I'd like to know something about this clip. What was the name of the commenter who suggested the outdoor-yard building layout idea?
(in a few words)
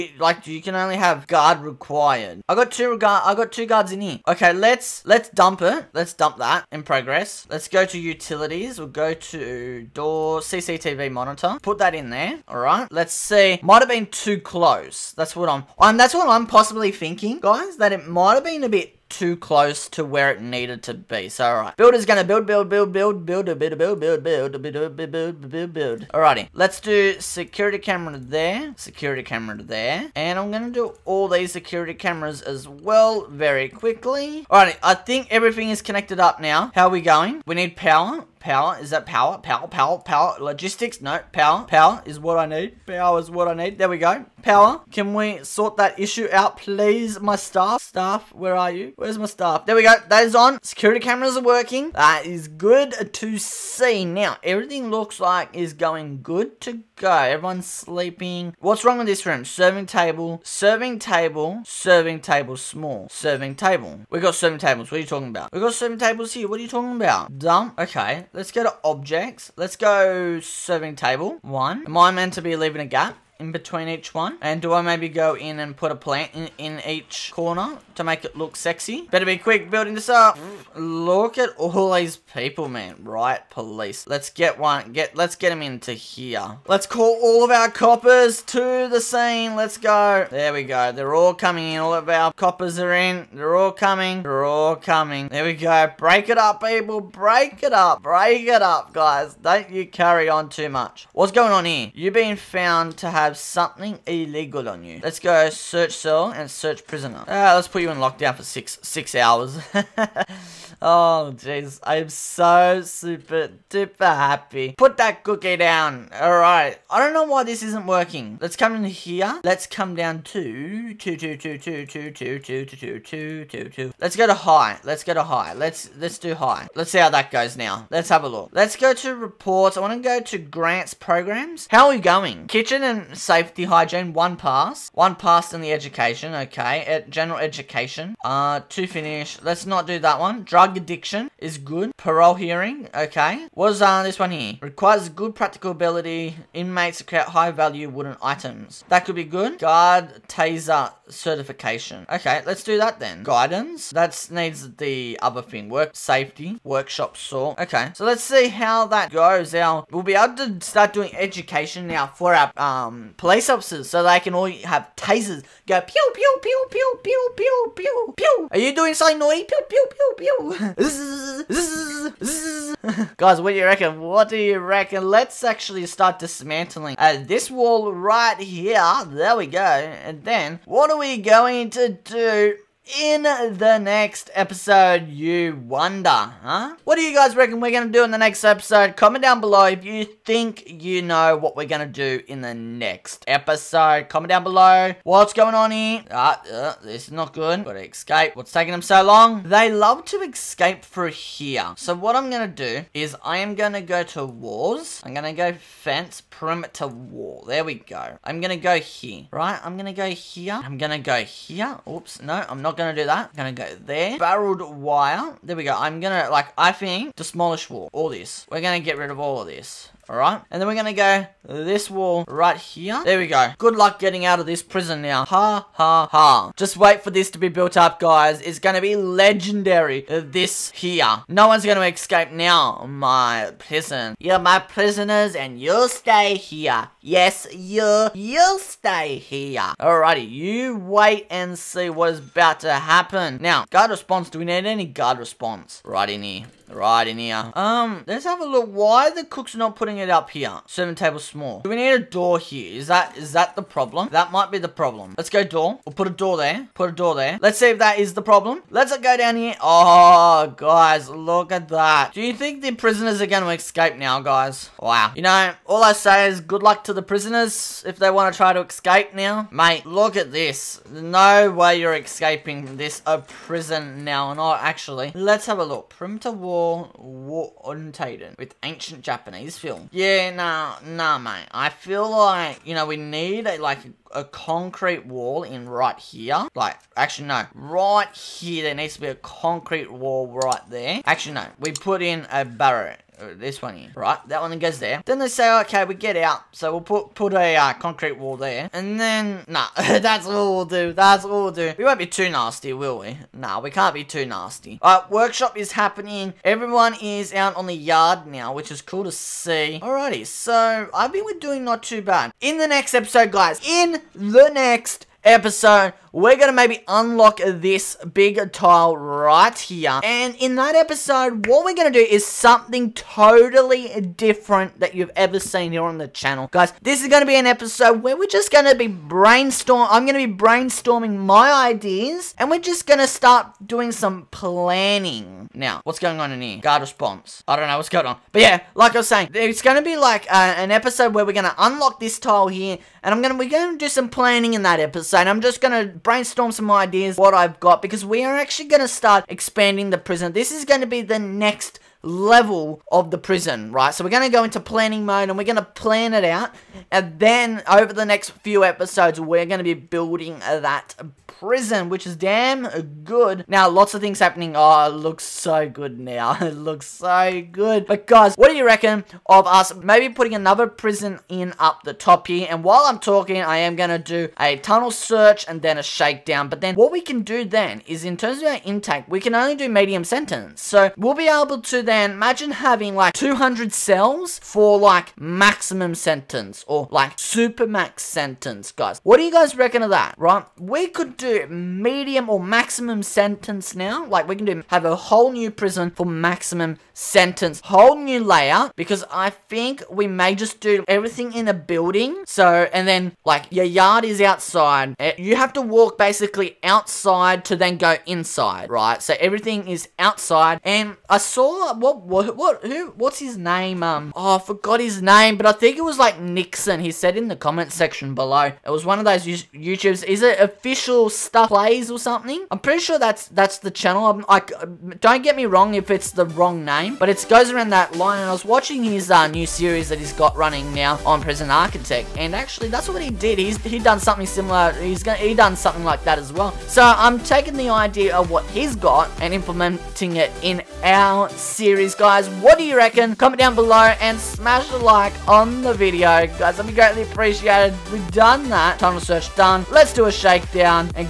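Nixon.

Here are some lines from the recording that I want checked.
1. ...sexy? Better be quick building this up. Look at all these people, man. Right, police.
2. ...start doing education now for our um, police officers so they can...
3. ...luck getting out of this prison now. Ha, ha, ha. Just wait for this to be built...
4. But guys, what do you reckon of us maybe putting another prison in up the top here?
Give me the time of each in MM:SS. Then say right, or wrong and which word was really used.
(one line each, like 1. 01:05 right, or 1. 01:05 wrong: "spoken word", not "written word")
1. 01:18 right
2. 02:40 right
3. 03:43 right
4. 06:07 right.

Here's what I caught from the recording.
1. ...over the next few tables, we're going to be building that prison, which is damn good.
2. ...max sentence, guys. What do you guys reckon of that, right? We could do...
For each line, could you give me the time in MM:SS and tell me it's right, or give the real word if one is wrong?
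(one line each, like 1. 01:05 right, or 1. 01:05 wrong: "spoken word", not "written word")
1. 05:57 wrong: "episodes", not "tables"
2. 06:27 right.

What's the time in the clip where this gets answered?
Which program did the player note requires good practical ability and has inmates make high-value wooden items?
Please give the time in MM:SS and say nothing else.
02:36.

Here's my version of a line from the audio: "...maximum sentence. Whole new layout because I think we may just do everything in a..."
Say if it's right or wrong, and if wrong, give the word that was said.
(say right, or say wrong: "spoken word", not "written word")
right.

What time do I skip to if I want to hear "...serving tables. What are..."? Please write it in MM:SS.
01:04.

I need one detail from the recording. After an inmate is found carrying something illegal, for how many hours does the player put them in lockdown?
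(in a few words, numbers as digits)
6.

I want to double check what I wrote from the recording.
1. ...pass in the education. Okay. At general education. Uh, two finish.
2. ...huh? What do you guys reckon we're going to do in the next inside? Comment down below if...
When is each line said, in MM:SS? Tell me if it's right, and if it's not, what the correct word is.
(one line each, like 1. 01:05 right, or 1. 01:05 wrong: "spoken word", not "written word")
1. 02:15 right
2. 03:06 wrong: "episode", not "inside".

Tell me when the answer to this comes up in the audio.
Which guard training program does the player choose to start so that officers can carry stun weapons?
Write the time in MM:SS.
02:29.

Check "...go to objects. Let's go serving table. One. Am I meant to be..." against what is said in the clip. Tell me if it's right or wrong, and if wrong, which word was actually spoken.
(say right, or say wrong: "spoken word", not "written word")
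right.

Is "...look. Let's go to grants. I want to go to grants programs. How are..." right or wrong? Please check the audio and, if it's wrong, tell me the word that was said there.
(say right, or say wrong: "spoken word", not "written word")
wrong: "reports", not "grants".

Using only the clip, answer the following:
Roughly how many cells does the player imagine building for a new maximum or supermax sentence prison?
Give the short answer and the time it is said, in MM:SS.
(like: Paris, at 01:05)
200, at 06:23.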